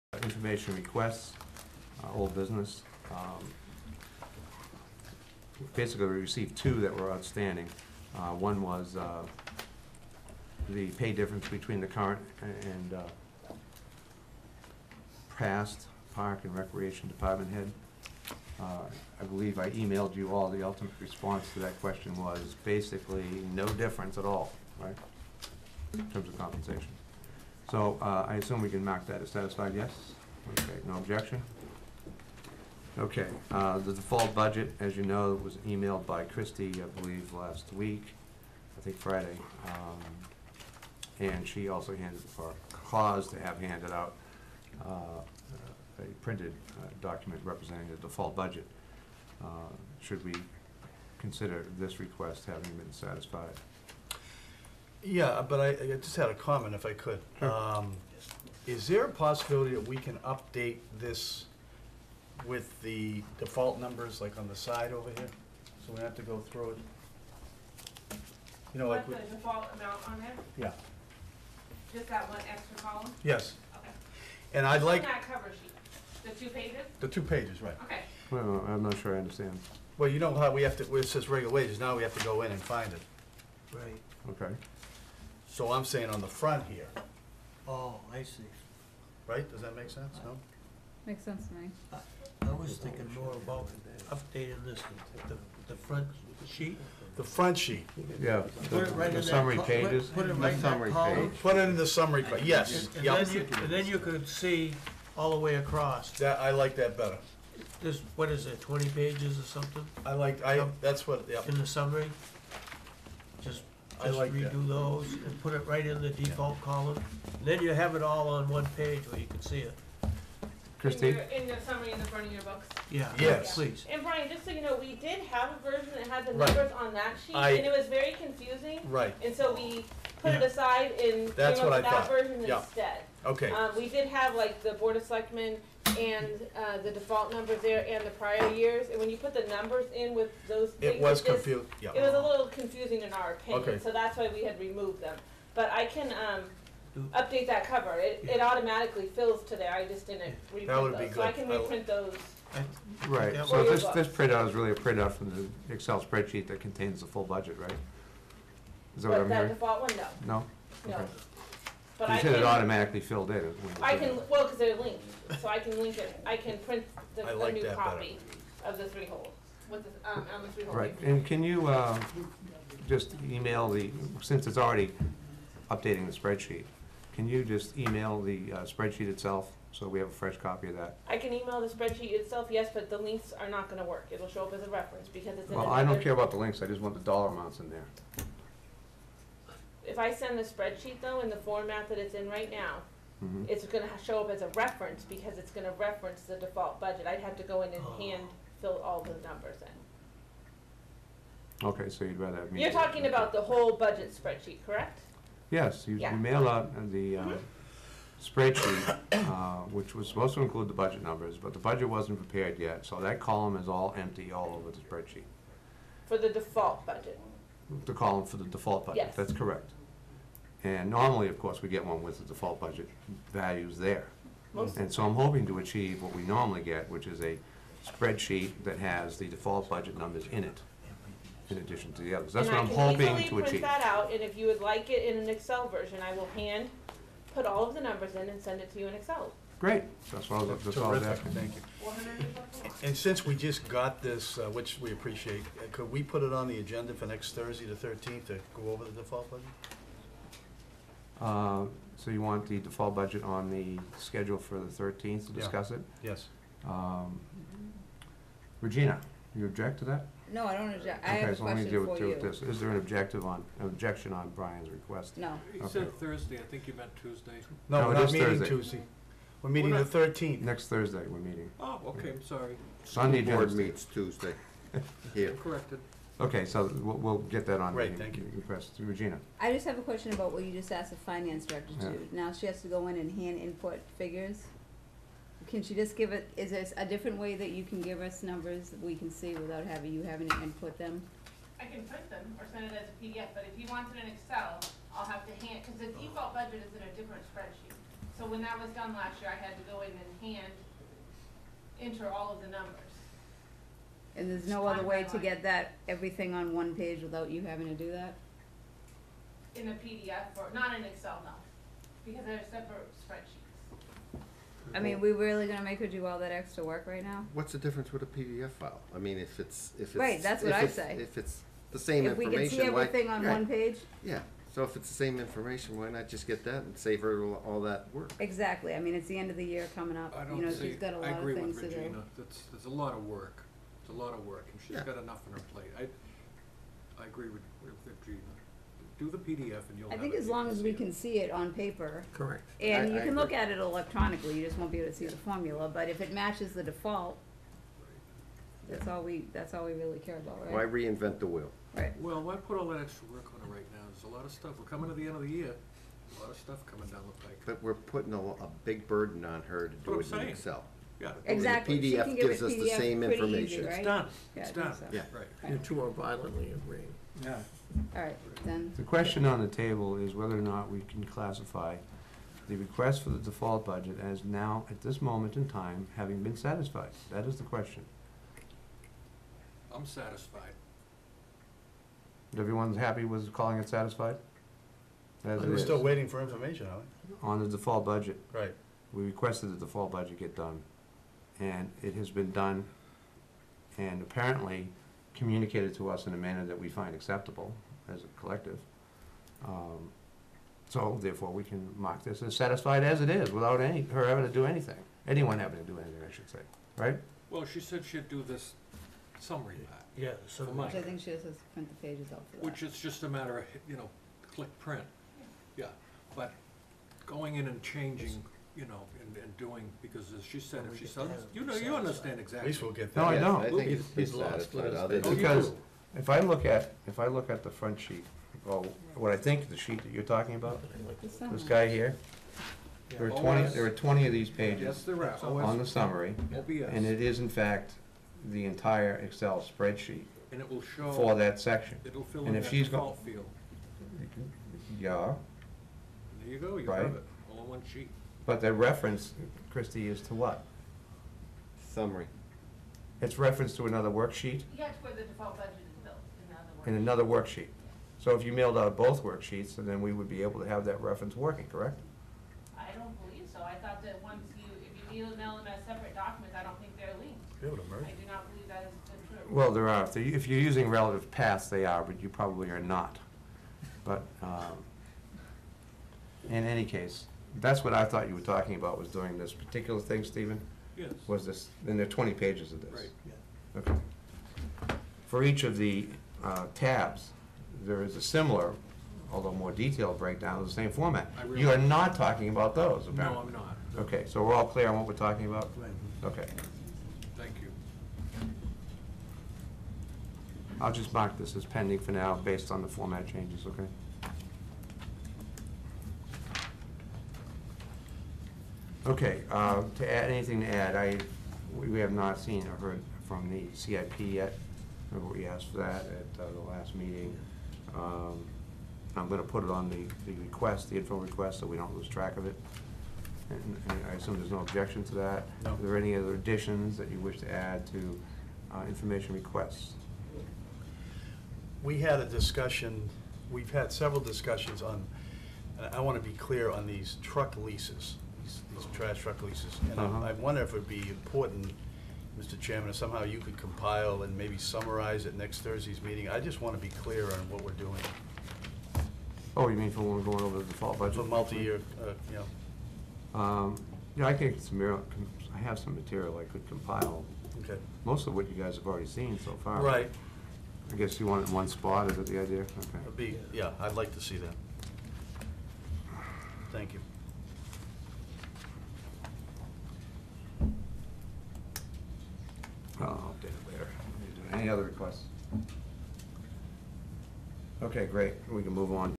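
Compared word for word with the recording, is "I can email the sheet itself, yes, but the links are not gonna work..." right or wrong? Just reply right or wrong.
wrong.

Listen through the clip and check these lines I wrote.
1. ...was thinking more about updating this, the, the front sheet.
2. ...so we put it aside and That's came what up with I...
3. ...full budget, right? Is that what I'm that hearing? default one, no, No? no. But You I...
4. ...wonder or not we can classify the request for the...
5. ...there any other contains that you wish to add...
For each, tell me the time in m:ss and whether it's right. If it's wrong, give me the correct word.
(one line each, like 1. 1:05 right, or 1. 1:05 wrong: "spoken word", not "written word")
1. 1:32 right
2. 2:09 right
3. 2:37 right
4. 6:10 wrong: "whether", not "wonder"
5. 8:45 wrong: "additions", not "contains".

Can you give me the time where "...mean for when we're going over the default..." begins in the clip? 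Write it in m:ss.
9:09.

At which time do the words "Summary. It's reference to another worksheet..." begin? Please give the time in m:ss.
7:31.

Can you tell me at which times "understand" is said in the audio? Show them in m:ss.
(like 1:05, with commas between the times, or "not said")
1:19, 7:01.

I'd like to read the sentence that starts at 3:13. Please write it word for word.
it's gonna show up as a reference because it's gonna reference the default budget.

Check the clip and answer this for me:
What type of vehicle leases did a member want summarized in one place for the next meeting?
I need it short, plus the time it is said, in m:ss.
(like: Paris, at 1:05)
Trash truck, at 8:58.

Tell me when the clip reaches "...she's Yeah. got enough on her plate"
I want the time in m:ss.
5:34.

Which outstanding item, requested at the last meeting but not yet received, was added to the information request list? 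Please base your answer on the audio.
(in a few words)
The CIP.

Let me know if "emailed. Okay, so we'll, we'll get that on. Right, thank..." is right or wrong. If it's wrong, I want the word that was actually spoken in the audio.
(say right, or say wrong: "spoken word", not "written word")
wrong: "corrected", not "emailed".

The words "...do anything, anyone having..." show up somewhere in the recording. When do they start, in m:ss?
6:44.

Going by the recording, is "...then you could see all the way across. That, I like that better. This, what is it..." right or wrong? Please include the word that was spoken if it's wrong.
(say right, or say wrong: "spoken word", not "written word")
right.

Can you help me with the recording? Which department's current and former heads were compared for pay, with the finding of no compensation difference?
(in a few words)
Park and Recreation.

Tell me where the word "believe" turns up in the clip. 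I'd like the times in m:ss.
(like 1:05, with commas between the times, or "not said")
0:19, 0:37, 7:43, 7:48.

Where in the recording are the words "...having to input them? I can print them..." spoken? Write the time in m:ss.
4:50.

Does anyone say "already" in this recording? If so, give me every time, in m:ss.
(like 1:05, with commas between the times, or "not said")
2:54, 9:18.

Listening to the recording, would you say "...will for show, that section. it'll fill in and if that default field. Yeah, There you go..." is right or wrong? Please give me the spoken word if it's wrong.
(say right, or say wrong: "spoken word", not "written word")
right.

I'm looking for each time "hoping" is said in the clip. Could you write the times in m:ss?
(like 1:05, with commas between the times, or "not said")
3:45, 3:52.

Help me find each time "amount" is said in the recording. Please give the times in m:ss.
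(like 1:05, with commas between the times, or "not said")
1:09, 3:07.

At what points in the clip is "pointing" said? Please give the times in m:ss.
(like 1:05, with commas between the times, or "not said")
not said.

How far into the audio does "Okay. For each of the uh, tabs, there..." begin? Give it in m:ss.
8:03.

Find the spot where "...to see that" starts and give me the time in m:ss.
9:23.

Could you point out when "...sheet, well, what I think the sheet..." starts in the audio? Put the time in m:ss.
7:07.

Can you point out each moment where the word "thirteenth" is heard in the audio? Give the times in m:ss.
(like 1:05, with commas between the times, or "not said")
4:07, 4:29.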